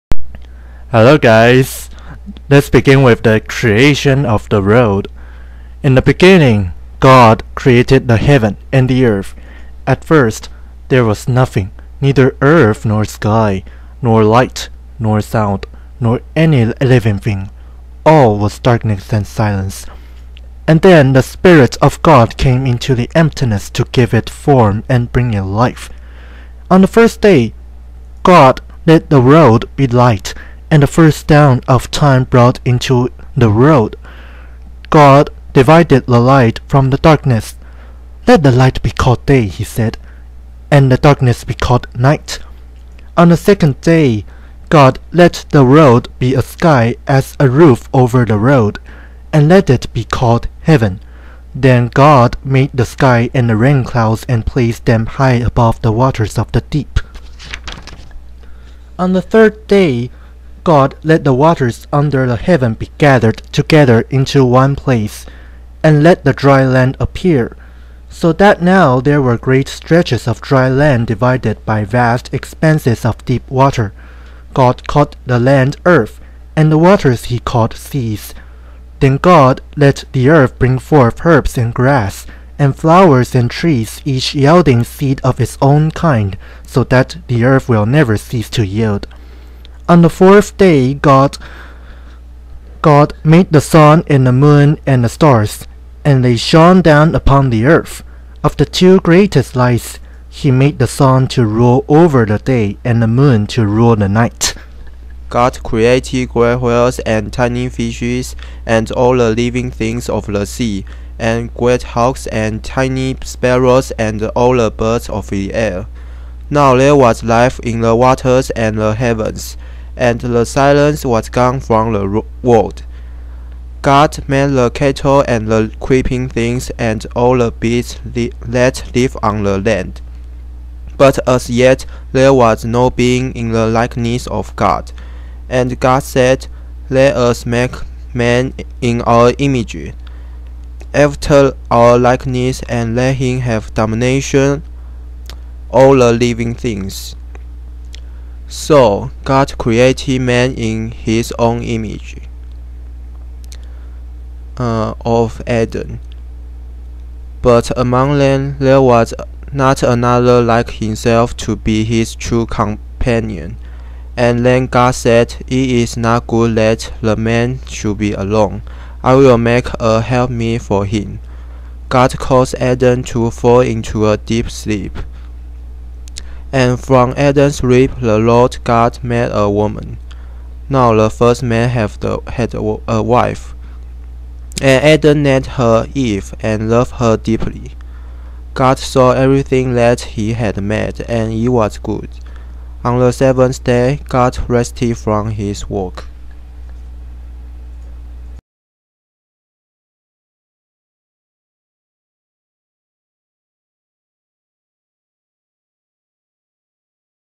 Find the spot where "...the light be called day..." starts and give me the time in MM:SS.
00:38.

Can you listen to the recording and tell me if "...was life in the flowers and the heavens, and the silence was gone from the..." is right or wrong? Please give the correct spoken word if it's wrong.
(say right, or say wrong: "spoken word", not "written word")
wrong: "waters", not "flowers".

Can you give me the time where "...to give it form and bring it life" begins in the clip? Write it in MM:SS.
00:23.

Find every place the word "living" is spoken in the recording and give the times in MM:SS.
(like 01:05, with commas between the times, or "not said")
00:16, 01:49, 02:26.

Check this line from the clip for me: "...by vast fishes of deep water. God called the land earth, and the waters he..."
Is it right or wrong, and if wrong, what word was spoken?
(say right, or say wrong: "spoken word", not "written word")
wrong: "expanses", not "fishes".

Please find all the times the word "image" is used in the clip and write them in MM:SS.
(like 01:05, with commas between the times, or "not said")
02:19, 02:31.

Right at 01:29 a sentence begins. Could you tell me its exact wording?
On the fourth day, God, God made the sun and the moon and the stars, and they shone down upon the earth.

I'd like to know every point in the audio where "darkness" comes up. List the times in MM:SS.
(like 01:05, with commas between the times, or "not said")
00:18, 00:36, 00:40.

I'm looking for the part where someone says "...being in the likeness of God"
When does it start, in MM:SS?
02:12.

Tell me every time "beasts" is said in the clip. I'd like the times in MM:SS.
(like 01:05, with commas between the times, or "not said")
02:07.